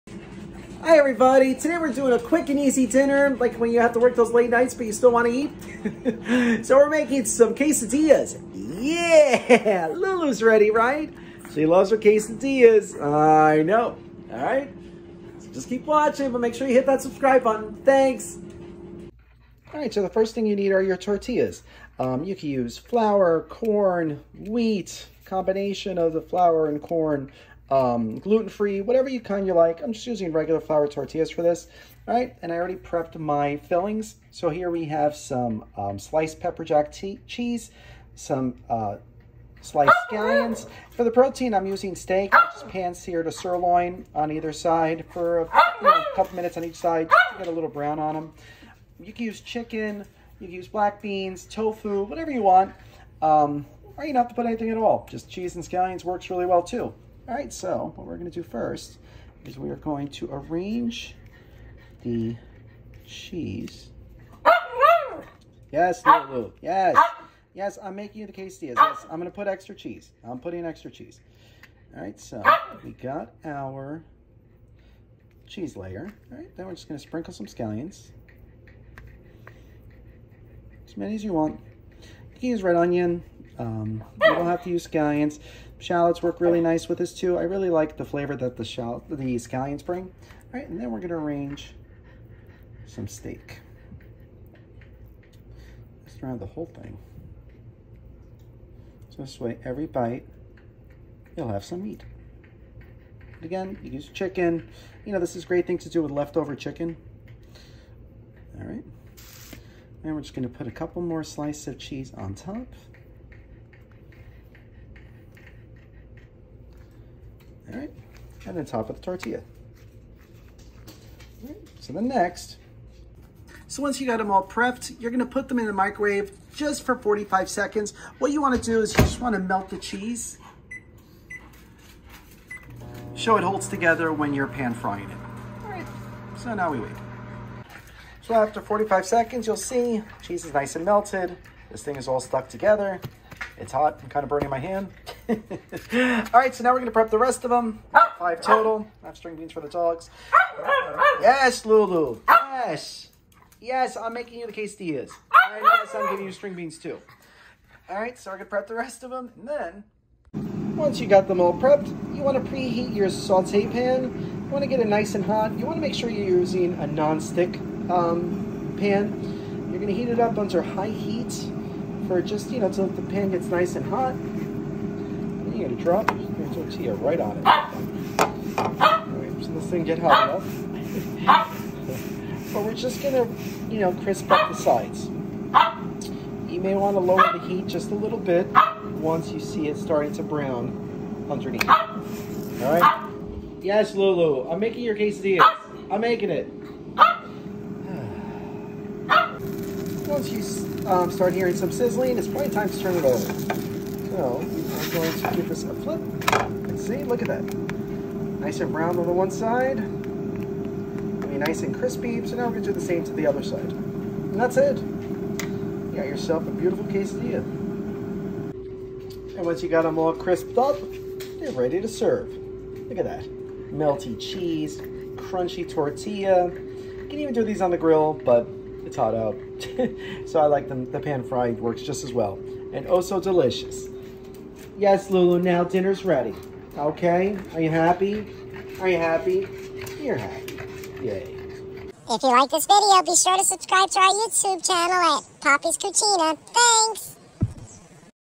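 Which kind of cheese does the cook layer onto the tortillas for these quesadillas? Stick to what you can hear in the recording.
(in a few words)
Pepper jack.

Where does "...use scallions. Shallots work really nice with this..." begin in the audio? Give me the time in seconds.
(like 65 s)
84 s.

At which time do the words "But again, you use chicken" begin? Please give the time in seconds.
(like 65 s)
103 s.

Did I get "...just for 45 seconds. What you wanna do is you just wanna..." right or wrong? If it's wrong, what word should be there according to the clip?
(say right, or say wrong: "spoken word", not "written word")
right.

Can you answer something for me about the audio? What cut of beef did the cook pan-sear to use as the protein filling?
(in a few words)
Sirloin.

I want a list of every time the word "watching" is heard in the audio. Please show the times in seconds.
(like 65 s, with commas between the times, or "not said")
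15 s.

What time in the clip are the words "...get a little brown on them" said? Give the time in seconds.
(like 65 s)
47 s.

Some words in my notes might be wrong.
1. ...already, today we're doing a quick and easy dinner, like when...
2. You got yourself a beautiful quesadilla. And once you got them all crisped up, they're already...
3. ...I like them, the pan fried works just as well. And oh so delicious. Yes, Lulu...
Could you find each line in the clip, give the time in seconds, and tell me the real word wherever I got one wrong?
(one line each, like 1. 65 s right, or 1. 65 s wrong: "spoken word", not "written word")
1. 0 s wrong: "everybody", not "already"
2. 214 s wrong: "ready", not "already"
3. 230 s right.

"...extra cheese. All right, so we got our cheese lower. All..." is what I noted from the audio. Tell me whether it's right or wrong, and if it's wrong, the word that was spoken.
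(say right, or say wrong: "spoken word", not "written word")
wrong: "layer", not "lower".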